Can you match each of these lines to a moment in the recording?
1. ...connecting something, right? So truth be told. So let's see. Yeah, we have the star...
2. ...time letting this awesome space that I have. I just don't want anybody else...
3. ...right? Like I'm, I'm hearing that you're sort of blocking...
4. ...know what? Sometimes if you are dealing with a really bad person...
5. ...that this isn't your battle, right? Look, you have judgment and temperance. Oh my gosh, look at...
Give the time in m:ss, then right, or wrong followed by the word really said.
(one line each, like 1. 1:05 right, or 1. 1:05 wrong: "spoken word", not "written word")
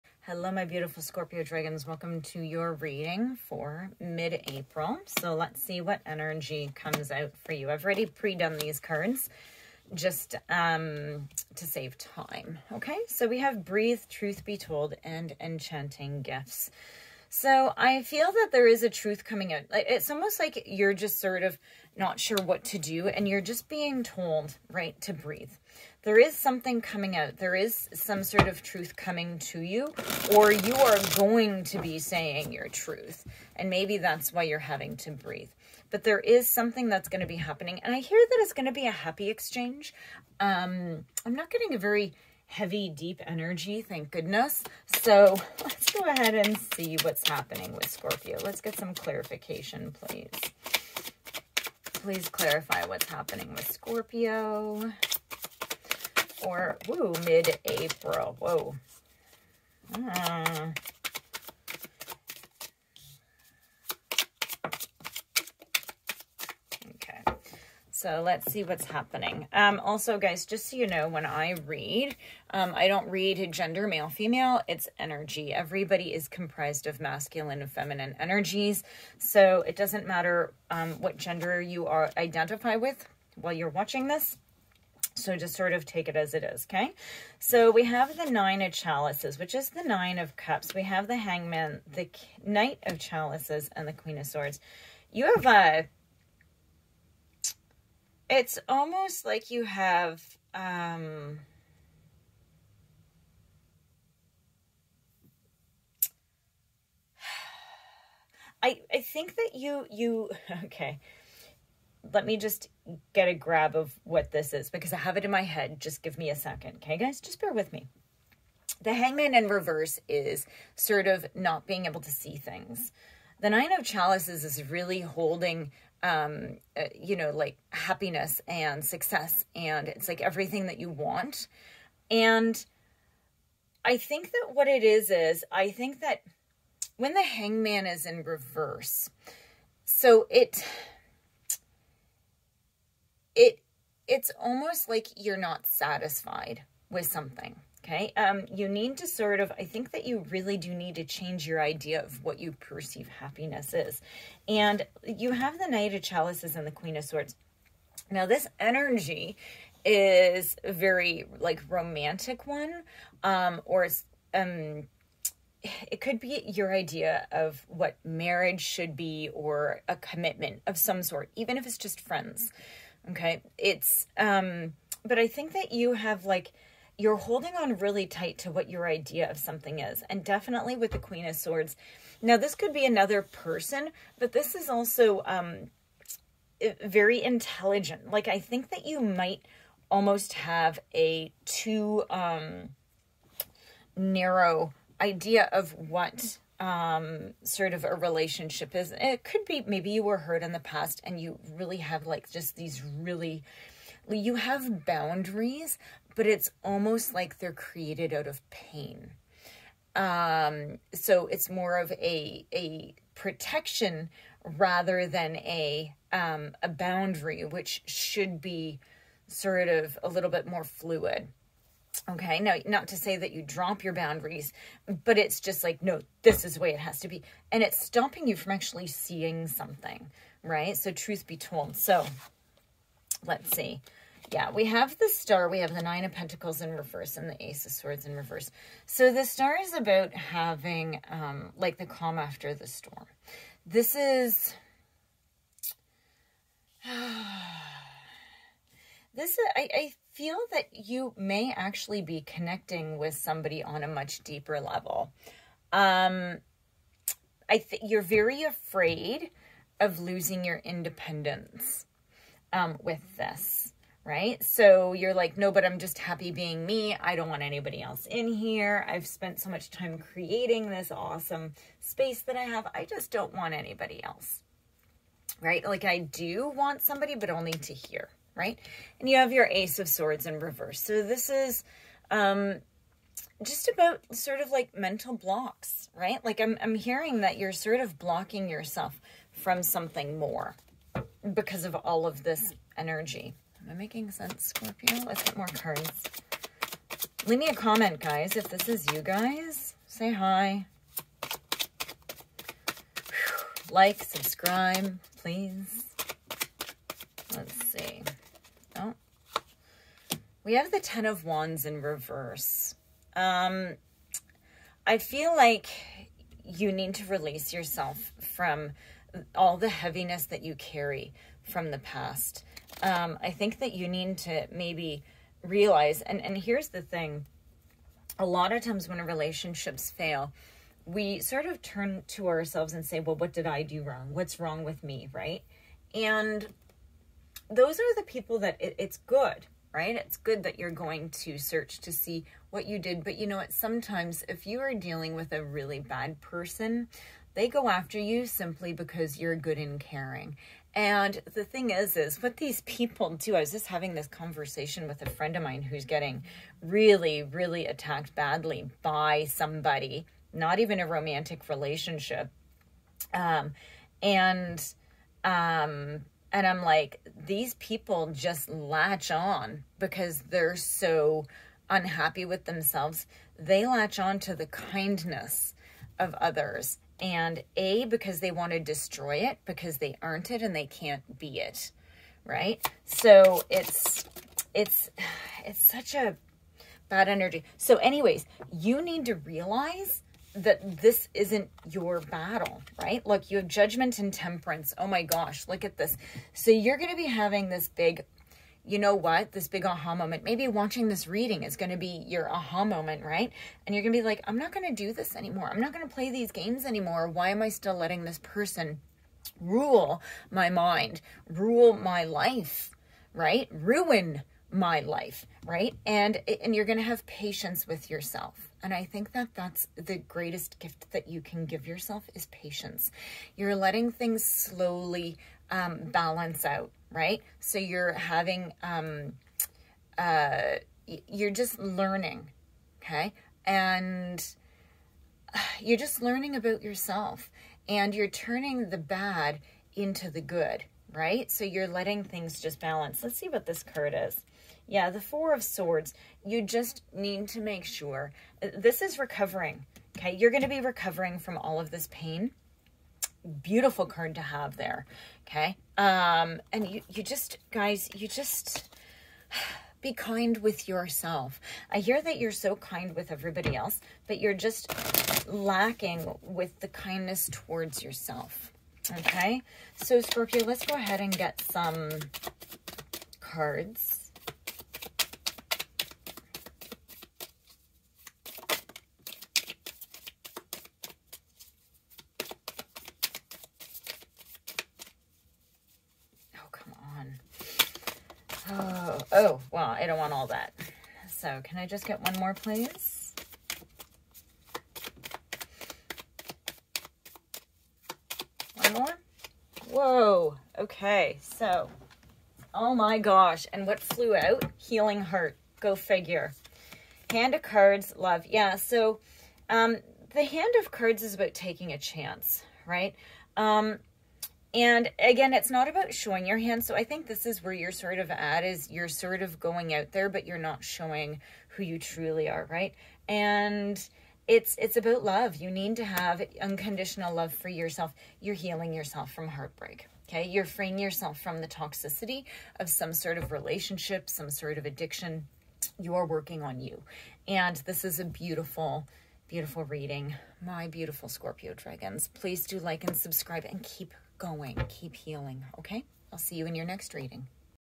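1. 3:48 wrong: "seeing", not "connecting"
2. 4:29 wrong: "creating", not "letting"
3. 4:45 right
4. 5:43 right
5. 6:30 right.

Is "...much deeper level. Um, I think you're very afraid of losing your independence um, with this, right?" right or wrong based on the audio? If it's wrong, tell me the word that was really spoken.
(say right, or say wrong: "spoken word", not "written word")
right.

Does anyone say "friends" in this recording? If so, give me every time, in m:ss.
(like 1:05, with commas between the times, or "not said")
2:52, 5:55.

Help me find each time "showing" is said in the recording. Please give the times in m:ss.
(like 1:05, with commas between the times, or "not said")
8:35, 8:40.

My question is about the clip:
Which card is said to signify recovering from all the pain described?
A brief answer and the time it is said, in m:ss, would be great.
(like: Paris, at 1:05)
Four of Swords, at 7:25.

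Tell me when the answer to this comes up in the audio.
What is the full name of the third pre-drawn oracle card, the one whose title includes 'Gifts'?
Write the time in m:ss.
0:15.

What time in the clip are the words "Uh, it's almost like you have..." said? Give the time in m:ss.
1:35.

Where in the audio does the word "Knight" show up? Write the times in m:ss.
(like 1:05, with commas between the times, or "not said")
1:32, 2:35.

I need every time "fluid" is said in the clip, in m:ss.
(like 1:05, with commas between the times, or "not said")
3:40.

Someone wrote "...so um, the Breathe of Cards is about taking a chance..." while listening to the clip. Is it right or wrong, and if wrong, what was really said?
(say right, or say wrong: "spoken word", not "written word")
wrong: "Hand", not "Breathe".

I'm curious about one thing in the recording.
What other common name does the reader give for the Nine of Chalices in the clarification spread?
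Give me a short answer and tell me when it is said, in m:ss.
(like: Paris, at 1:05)
Nine of Cups, at 1:29.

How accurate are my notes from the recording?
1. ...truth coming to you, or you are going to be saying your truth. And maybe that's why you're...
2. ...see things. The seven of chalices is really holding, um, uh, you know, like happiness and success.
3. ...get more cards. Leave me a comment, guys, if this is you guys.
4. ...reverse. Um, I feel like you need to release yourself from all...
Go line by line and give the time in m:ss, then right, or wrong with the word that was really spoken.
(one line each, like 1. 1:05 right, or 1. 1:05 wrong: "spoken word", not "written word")
1. 0:28 right
2. 2:02 wrong: "nine", not "seven"
3. 4:55 right
4. 5:11 right.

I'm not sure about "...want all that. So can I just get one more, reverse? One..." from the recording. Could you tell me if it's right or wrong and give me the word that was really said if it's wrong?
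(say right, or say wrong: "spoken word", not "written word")
wrong: "please", not "reverse".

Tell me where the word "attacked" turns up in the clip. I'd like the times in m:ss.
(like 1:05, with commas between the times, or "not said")
5:57.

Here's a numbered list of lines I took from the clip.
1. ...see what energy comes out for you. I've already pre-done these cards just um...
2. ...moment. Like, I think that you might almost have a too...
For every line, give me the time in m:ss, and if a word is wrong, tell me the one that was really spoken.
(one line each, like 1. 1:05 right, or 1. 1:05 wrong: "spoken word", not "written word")
1. 0:05 right
2. 3:07 wrong: "intelligent", not "moment".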